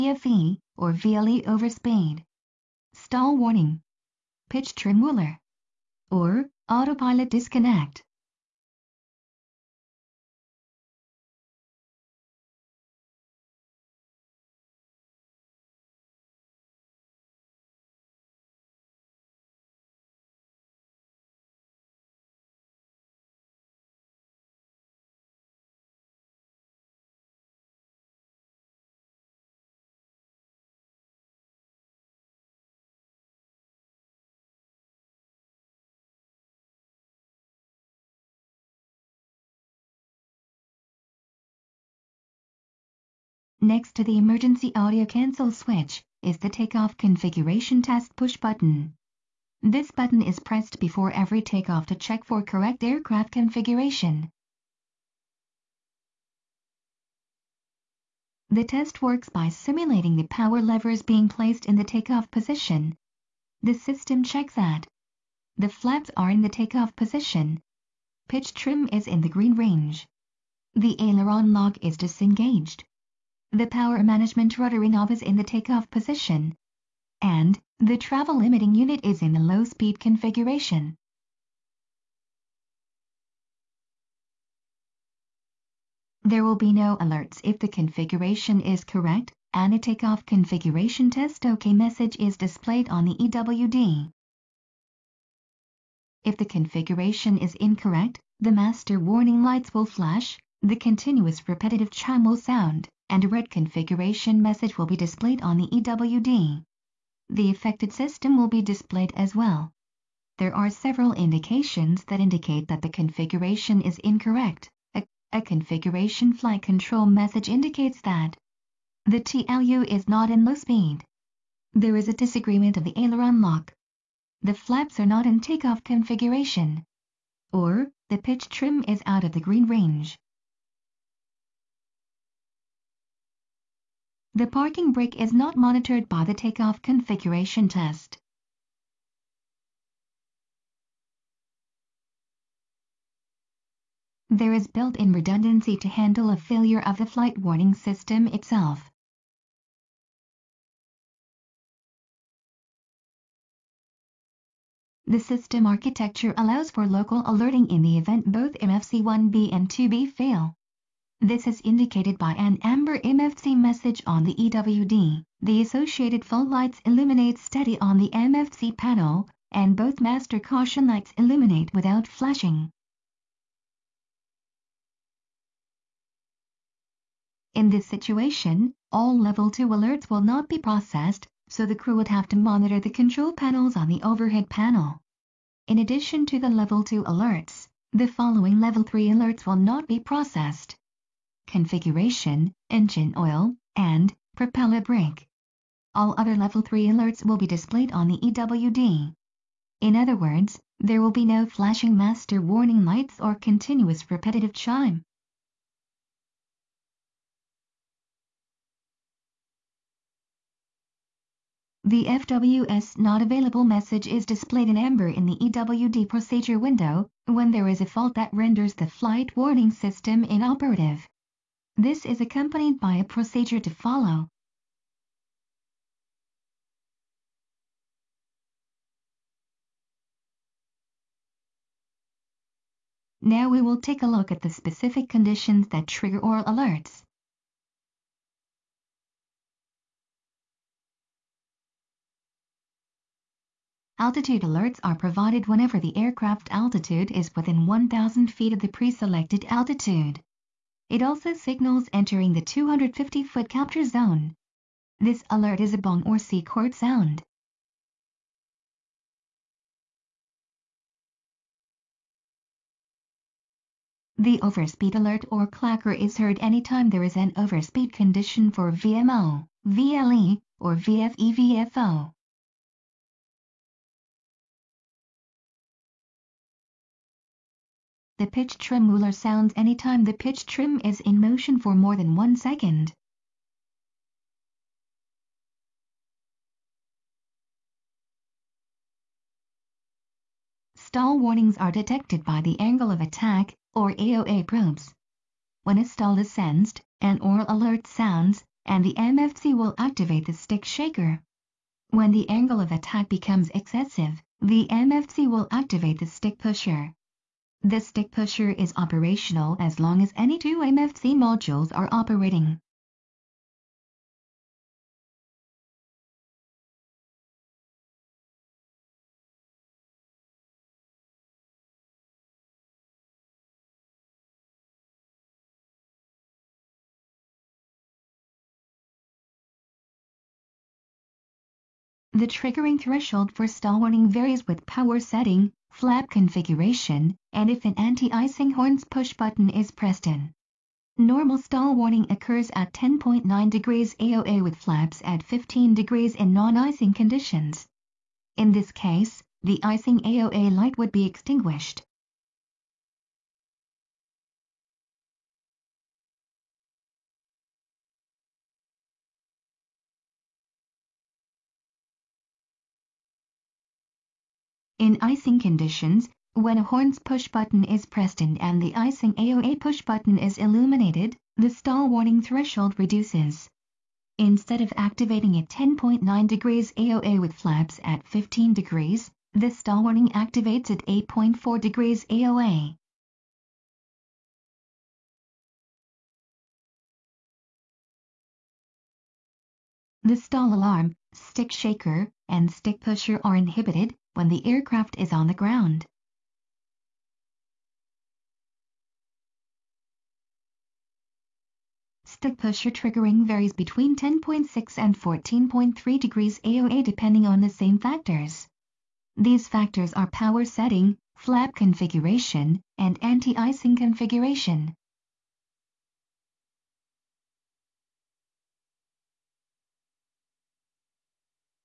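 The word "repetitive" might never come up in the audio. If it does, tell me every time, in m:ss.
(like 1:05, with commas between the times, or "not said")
1:41, 3:24.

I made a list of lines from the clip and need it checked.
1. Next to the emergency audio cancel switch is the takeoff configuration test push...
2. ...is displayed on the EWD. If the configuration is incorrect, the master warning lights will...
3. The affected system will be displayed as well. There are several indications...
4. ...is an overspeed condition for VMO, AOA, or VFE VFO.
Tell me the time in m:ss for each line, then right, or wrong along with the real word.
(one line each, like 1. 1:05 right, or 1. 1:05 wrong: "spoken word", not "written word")
1. 0:43 right
2. 1:32 right
3. 1:47 right
4. 4:27 wrong: "VLE", not "AOA".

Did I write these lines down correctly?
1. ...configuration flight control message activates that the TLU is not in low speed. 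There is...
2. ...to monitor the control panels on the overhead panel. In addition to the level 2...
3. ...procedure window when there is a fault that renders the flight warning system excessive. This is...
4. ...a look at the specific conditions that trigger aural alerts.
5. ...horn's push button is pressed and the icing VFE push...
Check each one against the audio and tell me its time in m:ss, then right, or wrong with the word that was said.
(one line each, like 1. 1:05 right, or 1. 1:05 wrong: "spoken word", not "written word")
1. 1:55 wrong: "indicates", not "activates"
2. 3:02 right
3. 3:36 wrong: "inoperative", not "excessive"
4. 3:54 right
5. 6:06 wrong: "AOA", not "VFE".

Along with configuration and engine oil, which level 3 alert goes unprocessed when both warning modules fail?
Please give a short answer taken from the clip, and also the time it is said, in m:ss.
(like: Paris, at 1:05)
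Propeller brake, at 3:14.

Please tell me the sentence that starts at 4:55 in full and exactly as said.
When a stall is sensed, an aural alert sounds, and the MFC will activate the stick shaker.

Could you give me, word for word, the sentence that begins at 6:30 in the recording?
The stall alarm, stick shaker, and stick pusher are inhibited, when the aircraft is on the ground.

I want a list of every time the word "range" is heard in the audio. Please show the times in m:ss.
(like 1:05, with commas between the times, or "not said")
1:09, 2:09.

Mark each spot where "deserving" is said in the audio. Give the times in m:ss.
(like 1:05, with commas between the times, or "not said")
not said.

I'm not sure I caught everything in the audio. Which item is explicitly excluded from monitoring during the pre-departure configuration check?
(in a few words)
Parking brake.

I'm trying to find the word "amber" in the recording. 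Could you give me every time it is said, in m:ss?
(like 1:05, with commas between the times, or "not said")
2:42, 3:34.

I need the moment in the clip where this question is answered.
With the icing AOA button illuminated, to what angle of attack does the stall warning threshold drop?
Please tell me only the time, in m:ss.
6:20.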